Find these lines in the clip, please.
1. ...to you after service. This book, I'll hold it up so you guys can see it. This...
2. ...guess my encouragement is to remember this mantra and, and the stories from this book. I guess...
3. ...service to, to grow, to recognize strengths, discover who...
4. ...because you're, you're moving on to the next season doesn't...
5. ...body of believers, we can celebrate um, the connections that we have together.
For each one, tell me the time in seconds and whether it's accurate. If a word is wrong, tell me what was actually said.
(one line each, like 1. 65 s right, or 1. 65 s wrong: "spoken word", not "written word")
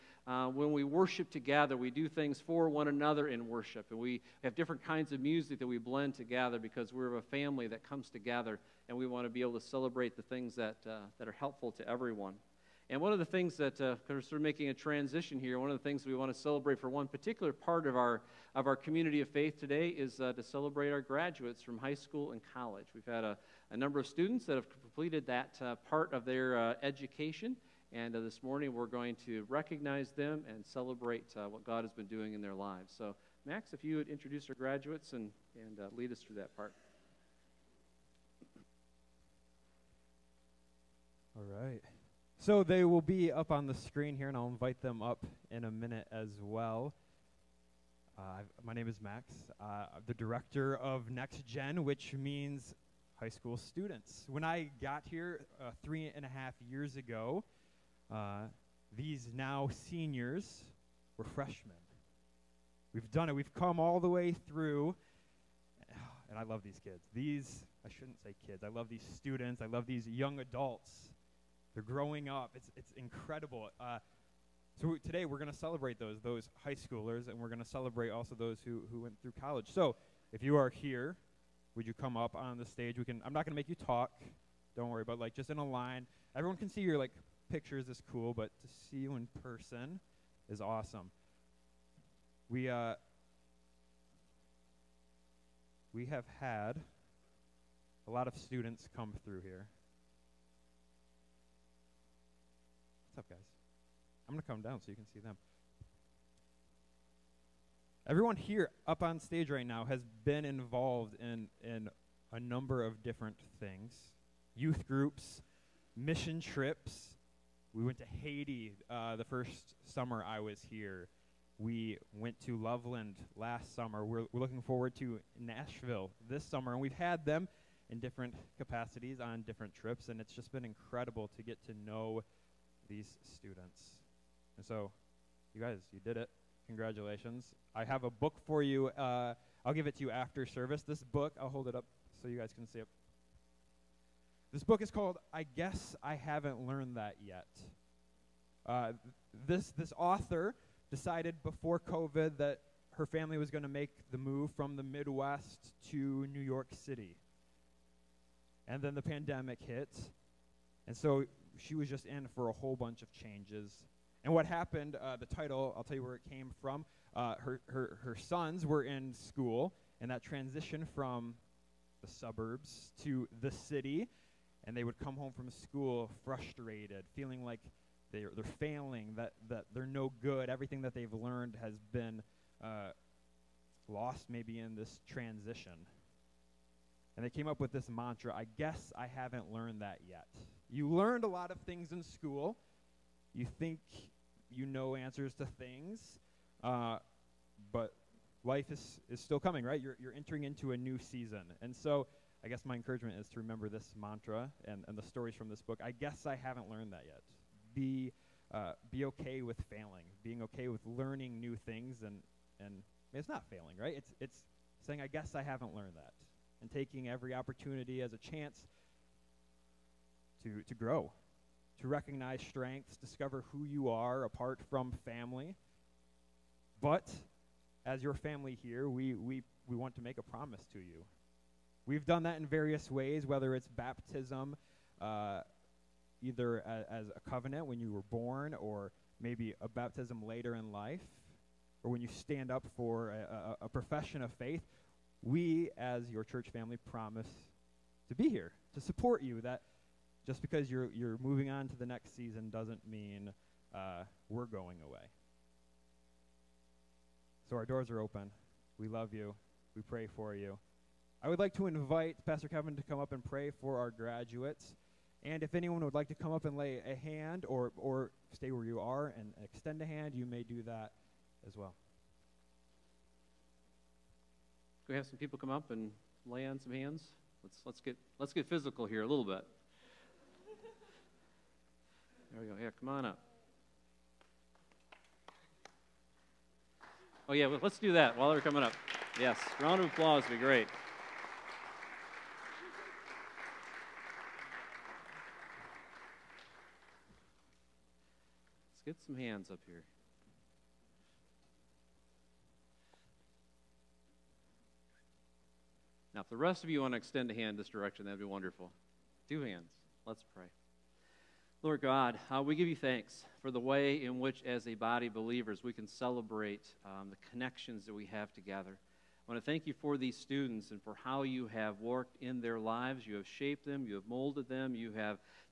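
1. 139 s right
2. 202 s right
3. 218 s wrong: "chance", not "service"
4. 250 s right
5. 314 s right.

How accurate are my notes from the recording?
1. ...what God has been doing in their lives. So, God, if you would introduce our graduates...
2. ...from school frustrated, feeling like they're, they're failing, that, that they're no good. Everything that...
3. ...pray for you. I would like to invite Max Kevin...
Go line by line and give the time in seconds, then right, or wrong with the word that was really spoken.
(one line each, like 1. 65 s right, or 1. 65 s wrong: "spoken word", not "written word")
1. 31 s wrong: "Max", not "God"
2. 175 s right
3. 259 s wrong: "Pastor", not "Max".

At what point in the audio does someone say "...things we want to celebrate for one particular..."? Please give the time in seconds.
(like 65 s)
15 s.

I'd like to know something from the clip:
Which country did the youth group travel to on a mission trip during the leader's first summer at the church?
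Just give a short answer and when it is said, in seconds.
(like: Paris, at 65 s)
Haiti, at 118 s.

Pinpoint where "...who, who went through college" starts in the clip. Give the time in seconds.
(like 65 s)
78 s.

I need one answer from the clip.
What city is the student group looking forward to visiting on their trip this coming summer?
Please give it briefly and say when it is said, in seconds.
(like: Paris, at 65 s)
Nashville, at 125 s.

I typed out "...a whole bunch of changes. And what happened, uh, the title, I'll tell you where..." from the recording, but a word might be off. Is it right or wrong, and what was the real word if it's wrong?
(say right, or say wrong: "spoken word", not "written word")
right.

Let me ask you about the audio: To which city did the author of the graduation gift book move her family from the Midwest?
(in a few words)
New York City.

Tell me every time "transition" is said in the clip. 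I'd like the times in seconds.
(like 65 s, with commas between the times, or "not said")
14 s, 170 s, 185 s.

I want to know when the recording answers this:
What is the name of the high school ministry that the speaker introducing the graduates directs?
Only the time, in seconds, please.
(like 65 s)
51 s.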